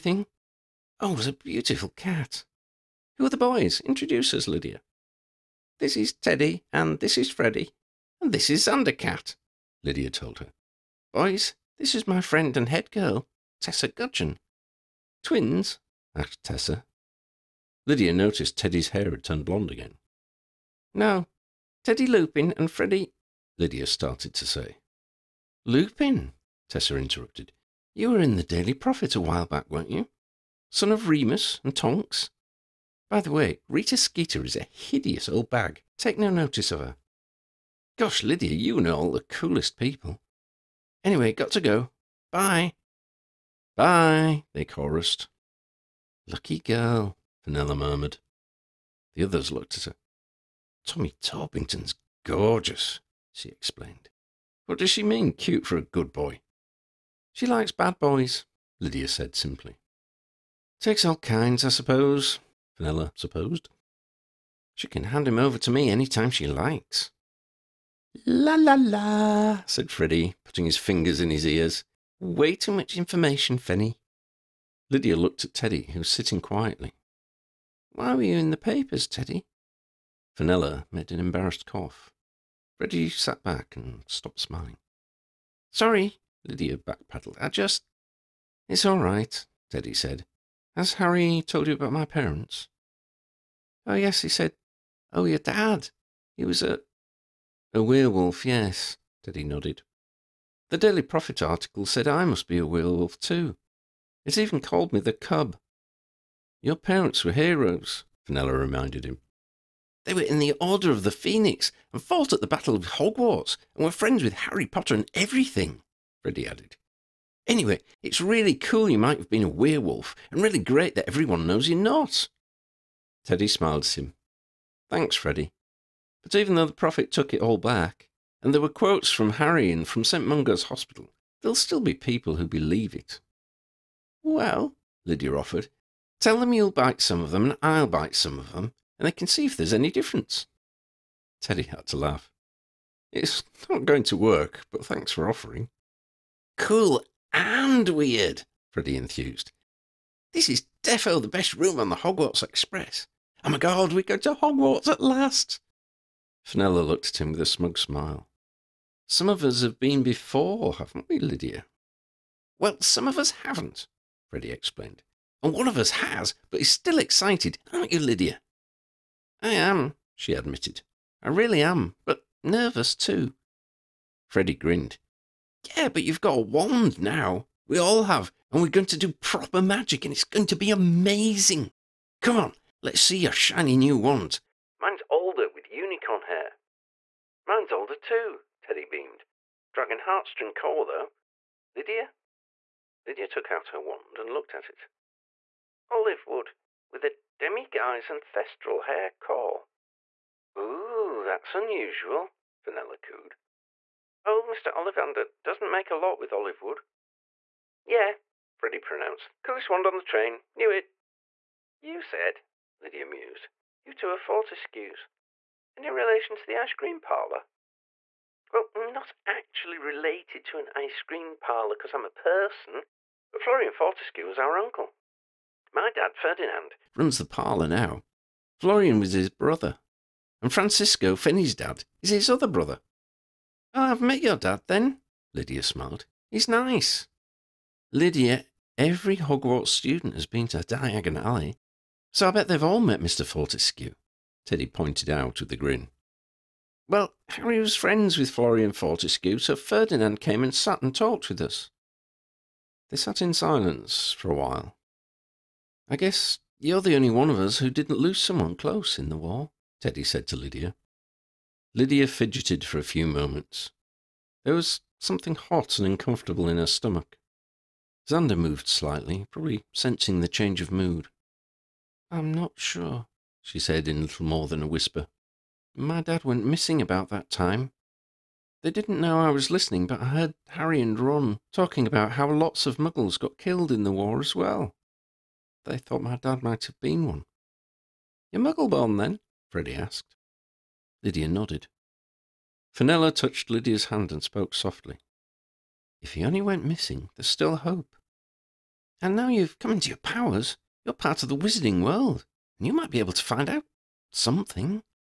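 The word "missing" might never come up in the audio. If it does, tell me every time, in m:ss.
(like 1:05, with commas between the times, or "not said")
4:36, 4:56.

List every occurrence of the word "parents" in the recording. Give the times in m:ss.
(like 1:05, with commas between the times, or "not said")
1:32, 1:46.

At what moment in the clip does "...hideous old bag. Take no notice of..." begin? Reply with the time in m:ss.
0:34.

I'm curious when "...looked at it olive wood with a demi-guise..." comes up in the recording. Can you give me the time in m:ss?
3:14.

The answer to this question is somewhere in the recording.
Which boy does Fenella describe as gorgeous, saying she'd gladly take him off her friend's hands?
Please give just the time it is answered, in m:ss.
0:50.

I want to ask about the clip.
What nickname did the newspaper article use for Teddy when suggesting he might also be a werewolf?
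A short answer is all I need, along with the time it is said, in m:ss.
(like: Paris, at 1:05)
the cub, at 1:45.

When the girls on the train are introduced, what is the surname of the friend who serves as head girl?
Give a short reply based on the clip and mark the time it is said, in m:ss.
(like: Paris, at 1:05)
Gudgeon, at 0:13.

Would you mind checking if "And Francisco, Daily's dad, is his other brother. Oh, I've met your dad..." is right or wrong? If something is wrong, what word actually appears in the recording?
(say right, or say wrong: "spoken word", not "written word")
wrong: "Finney", not "Daily".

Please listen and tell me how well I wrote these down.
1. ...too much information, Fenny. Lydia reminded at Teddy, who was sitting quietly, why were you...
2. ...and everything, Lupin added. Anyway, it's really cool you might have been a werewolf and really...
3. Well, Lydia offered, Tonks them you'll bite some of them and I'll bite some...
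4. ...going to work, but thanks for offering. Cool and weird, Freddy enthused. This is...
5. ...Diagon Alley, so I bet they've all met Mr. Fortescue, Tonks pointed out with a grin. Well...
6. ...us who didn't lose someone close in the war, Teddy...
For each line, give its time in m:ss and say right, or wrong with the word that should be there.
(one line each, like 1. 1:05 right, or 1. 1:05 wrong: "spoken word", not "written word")
1. 1:12 wrong: "looked", not "reminded"
2. 1:54 wrong: "Freddy", not "Lupin"
3. 2:14 wrong: "Tell", not "Tonks"
4. 2:23 right
5. 4:00 wrong: "Teddy", not "Tonks"
6. 4:17 right.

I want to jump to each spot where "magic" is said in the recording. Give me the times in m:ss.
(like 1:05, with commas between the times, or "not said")
2:59.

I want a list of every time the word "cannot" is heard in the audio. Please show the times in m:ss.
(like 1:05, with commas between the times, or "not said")
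not said.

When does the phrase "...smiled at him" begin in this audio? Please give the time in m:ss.
2:03.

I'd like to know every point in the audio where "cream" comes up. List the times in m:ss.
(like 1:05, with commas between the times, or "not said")
3:36, 3:41.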